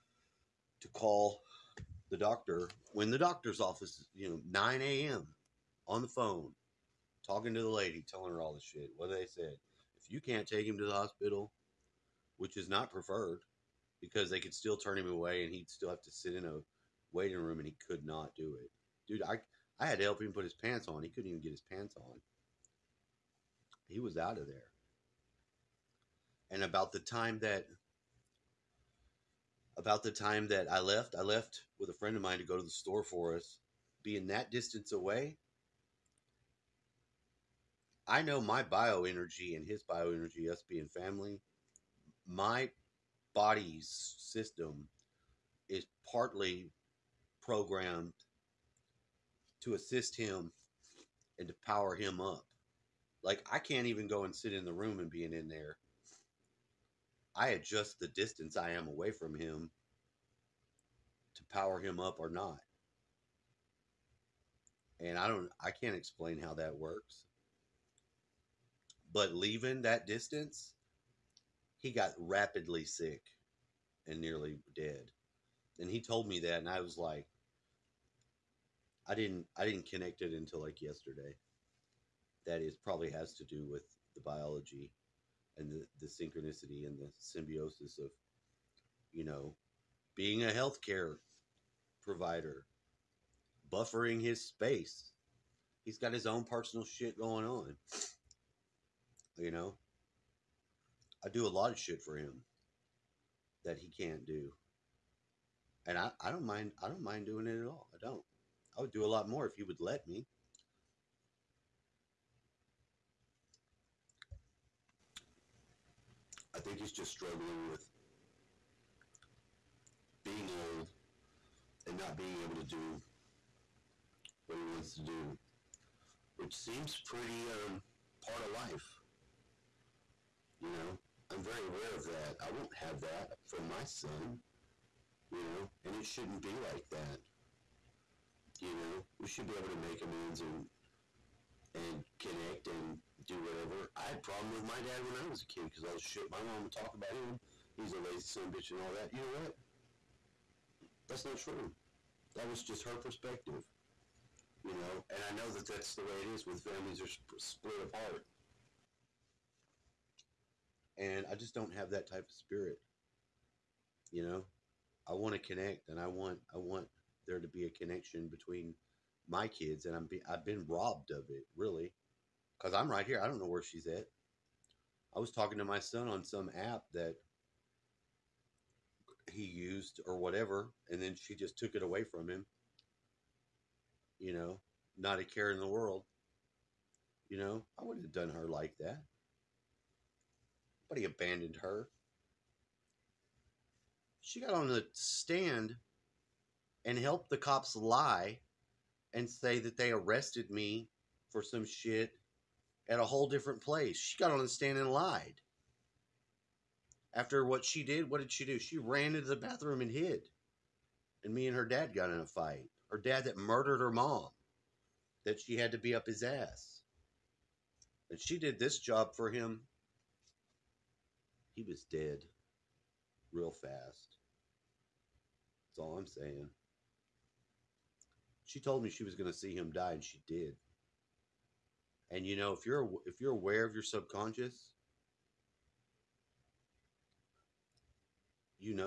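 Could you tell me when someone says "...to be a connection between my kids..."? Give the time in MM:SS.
02:47.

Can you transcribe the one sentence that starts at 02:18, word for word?
You know, we should be able to make amends and and connect and do whatever.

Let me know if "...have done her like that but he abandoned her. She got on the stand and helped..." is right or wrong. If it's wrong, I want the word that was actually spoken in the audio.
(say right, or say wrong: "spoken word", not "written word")
right.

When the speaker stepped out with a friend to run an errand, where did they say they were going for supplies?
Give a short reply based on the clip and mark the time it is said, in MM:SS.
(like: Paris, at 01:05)
the store, at 00:32.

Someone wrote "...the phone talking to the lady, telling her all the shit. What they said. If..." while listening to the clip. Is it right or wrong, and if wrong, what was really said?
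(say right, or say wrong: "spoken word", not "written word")
right.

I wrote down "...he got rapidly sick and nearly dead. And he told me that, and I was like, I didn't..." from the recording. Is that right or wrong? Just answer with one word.
right.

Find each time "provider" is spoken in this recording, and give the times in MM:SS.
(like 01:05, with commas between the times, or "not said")
01:32.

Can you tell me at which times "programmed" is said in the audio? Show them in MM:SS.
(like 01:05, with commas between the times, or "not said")
00:47.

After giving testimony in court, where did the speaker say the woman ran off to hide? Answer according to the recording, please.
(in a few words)
the bathroom.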